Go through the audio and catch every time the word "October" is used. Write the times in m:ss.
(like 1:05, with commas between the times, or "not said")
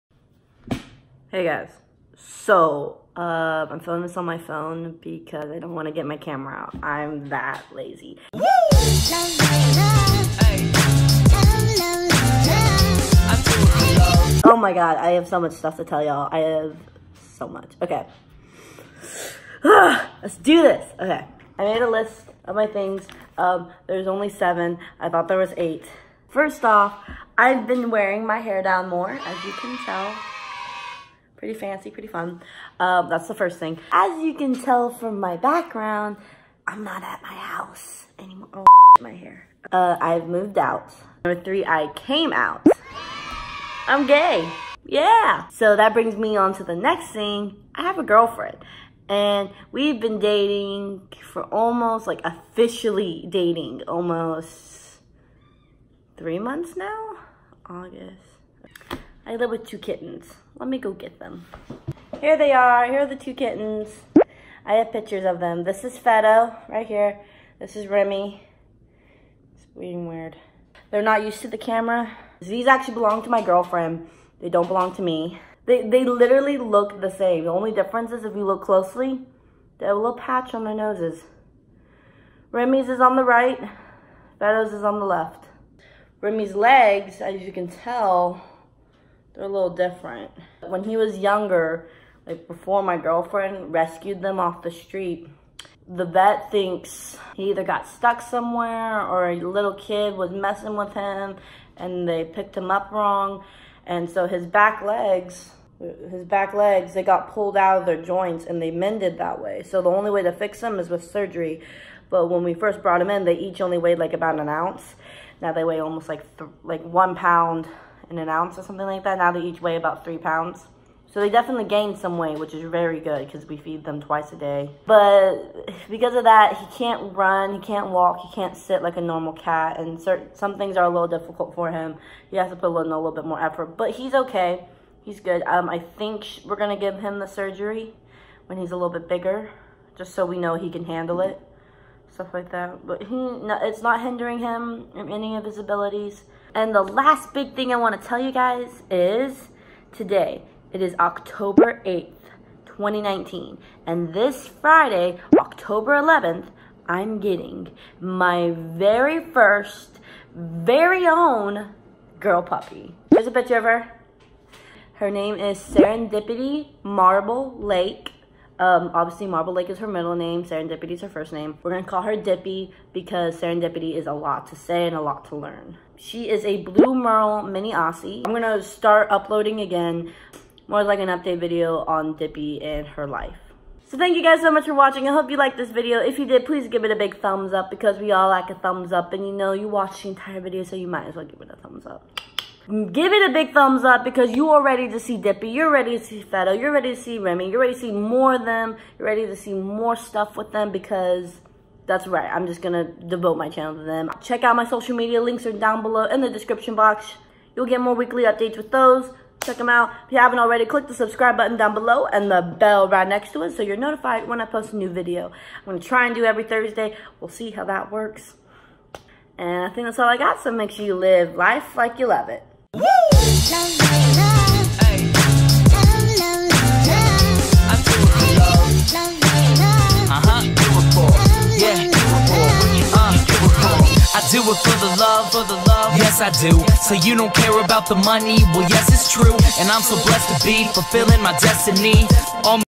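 2:30, 2:35.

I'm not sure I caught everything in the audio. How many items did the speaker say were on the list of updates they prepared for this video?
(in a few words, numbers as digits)
7.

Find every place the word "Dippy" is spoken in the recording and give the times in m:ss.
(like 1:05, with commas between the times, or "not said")
2:52, 3:02, 3:15.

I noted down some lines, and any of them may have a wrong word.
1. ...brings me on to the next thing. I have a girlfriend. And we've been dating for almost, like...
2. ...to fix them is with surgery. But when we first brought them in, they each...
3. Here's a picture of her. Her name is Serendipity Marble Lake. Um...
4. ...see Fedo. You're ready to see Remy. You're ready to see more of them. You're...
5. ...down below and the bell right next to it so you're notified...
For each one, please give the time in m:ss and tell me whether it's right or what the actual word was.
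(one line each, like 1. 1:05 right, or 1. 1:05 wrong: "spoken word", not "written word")
1. 0:45 right
2. 1:50 right
3. 2:43 right
4. 3:16 right
5. 3:31 right.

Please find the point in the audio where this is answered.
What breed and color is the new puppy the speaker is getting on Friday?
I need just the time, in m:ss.
2:56.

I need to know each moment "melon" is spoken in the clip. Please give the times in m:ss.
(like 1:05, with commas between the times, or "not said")
not said.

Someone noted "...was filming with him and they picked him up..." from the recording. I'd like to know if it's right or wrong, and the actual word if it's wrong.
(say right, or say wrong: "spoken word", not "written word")
wrong: "messing", not "filming".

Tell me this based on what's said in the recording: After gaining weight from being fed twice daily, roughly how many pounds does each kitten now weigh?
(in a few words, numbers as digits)
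3 pounds.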